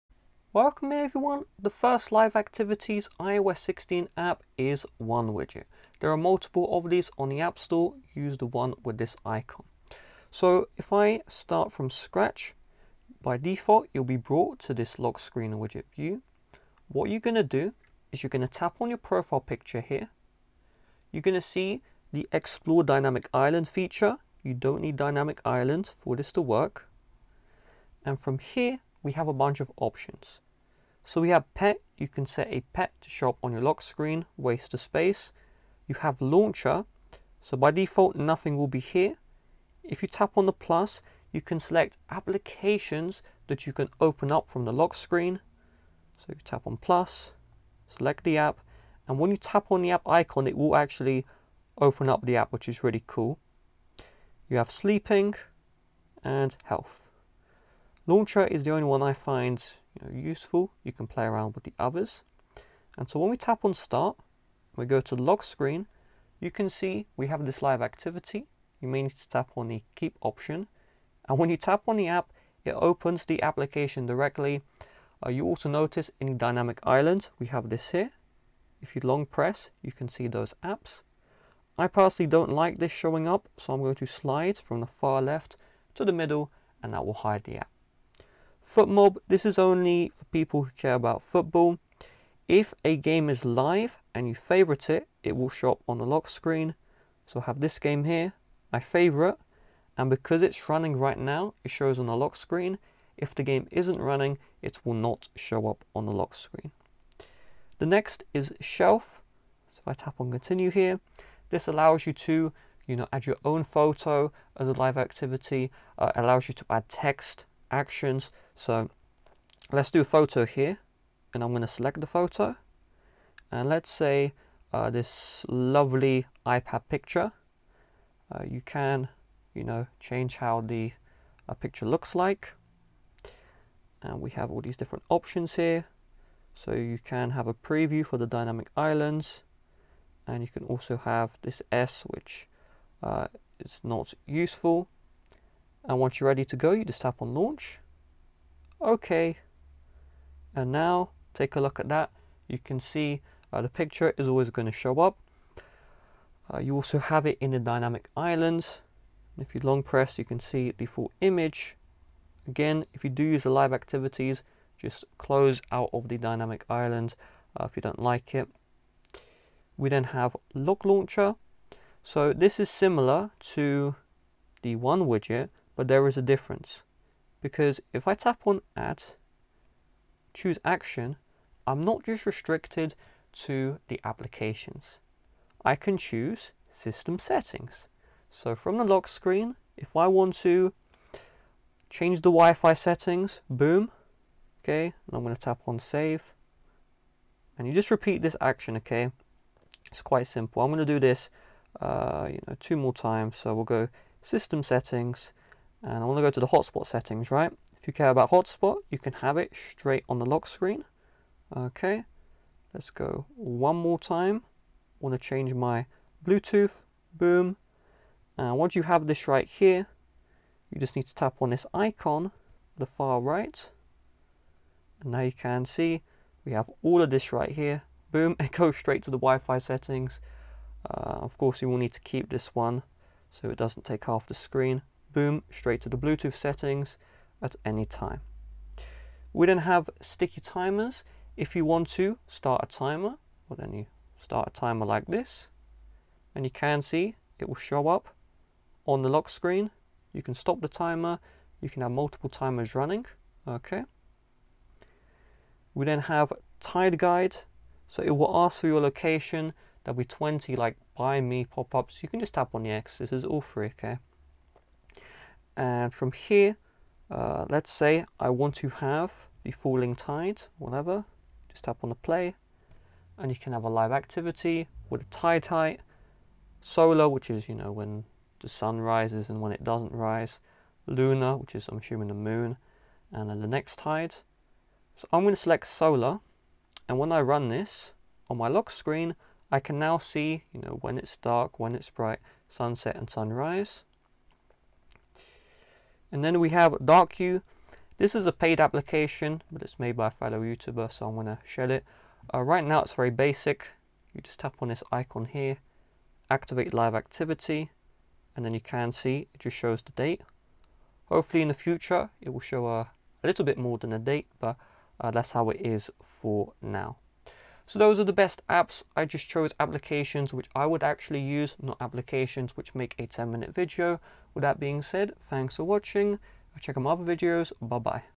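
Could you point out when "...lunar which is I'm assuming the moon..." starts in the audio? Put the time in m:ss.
4:40.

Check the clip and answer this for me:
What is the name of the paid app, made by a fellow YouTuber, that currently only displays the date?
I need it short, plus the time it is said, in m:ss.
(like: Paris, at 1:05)
Dark Hue, at 4:56.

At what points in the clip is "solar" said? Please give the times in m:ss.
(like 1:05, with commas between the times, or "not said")
4:36, 4:45.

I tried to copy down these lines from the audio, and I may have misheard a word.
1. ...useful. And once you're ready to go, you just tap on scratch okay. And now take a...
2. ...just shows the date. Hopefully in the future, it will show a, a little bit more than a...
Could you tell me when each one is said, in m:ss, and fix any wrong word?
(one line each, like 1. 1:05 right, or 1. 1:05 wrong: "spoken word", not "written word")
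1. 2:24 wrong: "launch", not "scratch"
2. 5:09 right.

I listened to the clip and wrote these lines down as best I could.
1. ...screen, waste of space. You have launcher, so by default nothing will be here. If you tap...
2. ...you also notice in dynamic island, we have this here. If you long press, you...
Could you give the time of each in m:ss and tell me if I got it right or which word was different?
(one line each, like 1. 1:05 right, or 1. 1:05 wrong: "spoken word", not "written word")
1. 0:33 right
2. 1:15 right.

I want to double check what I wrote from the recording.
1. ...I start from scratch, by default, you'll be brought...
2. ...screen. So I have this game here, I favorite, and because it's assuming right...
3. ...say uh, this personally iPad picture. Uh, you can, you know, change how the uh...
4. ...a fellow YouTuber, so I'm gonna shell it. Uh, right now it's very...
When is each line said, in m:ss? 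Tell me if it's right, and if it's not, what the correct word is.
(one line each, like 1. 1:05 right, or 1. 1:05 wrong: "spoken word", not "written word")
1. 0:10 right
2. 1:36 wrong: "running", not "assuming"
3. 2:03 wrong: "lovely", not "personally"
4. 5:00 right.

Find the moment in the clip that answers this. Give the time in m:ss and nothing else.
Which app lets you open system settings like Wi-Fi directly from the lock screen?
2:50.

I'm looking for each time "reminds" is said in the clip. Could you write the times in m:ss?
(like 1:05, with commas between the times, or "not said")
not said.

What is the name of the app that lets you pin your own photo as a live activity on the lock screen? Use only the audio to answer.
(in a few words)
Shelf.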